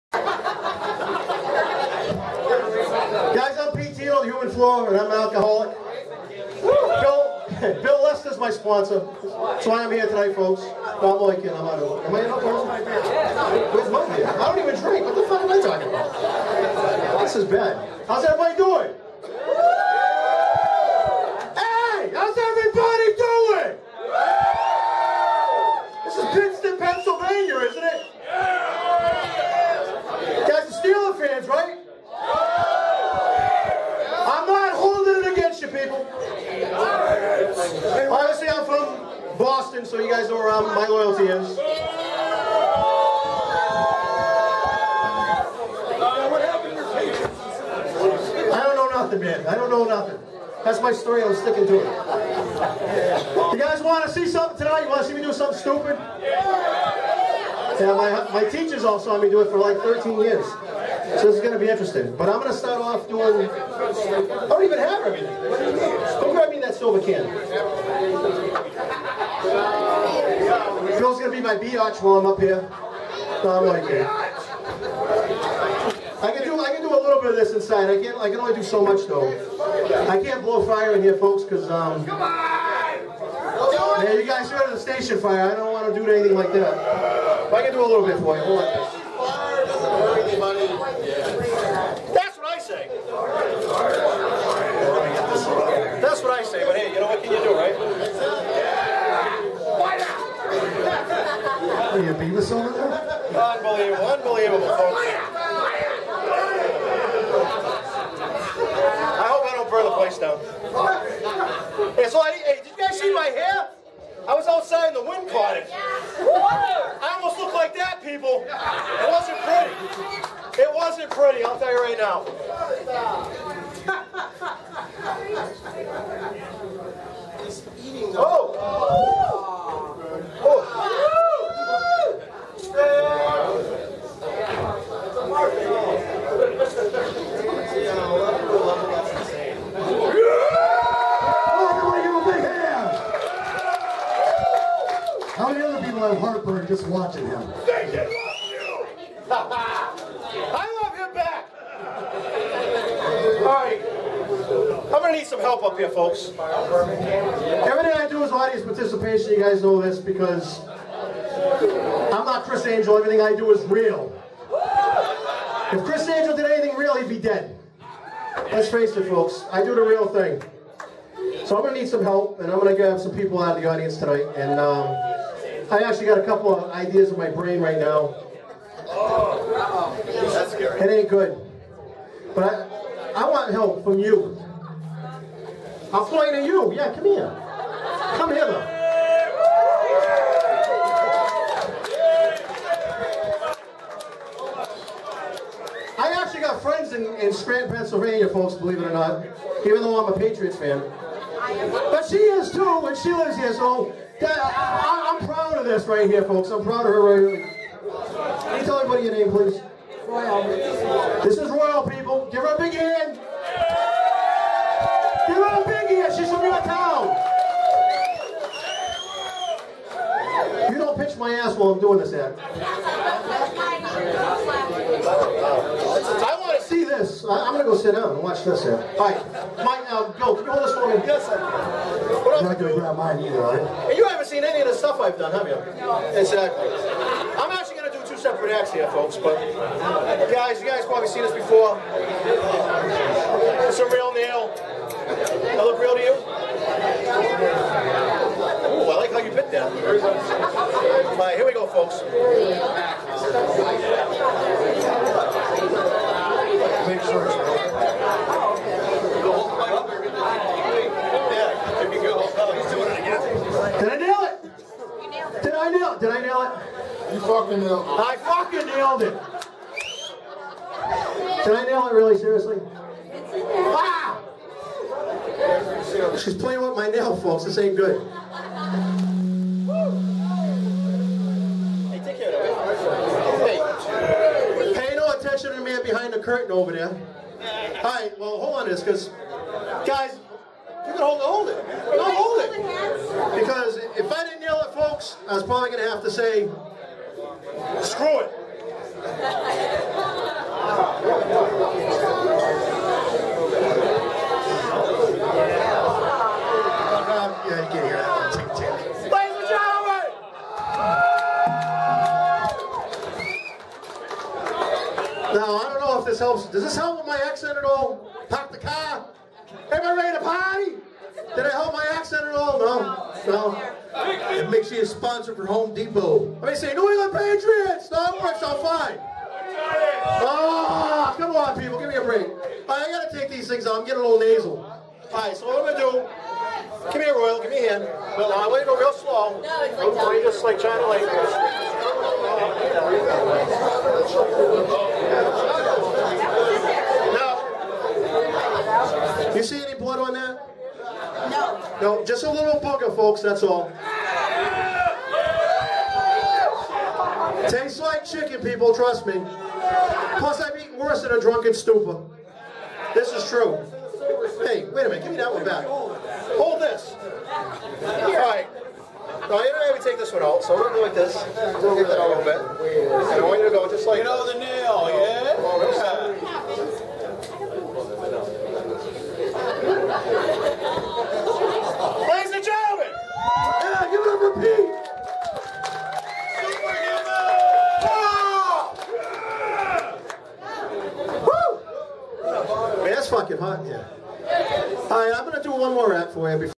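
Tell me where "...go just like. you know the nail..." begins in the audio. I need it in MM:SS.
06:13.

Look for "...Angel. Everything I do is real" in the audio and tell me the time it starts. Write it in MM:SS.
02:42.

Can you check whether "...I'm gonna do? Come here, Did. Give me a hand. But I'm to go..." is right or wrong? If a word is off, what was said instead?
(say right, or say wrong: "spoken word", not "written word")
wrong: "Royal", not "Did".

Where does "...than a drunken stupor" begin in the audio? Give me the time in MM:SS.
06:01.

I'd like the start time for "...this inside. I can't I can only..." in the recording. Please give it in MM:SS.
01:17.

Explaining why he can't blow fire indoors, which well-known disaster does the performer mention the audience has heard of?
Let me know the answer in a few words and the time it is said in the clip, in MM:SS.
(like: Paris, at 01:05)
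The Station fire, at 01:24.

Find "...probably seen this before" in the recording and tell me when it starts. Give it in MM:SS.
04:00.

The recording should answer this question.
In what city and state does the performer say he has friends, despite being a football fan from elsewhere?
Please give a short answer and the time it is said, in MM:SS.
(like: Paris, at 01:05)
Scranton, Pennsylvania, at 03:17.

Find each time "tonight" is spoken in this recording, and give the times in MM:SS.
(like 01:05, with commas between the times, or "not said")
00:10, 00:54, 02:53.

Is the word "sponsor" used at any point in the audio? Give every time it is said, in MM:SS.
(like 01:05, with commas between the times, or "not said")
00:08, 05:24.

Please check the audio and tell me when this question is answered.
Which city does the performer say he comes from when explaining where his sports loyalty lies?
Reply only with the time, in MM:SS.
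00:39.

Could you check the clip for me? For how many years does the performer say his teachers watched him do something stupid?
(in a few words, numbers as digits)
13.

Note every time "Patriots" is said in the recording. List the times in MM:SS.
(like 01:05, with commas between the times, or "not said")
03:20, 05:27.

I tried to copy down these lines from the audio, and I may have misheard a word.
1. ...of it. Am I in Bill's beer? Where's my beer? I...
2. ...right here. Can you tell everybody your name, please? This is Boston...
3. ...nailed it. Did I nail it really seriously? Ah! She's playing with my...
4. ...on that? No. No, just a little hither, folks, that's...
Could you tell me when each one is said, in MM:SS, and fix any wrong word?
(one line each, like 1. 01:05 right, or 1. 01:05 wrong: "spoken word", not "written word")
1. 00:11 wrong: "Where", not "Bill"
2. 03:27 wrong: "Roy", not "Boston"
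3. 04:28 right
4. 05:50 wrong: "booger", not "hither".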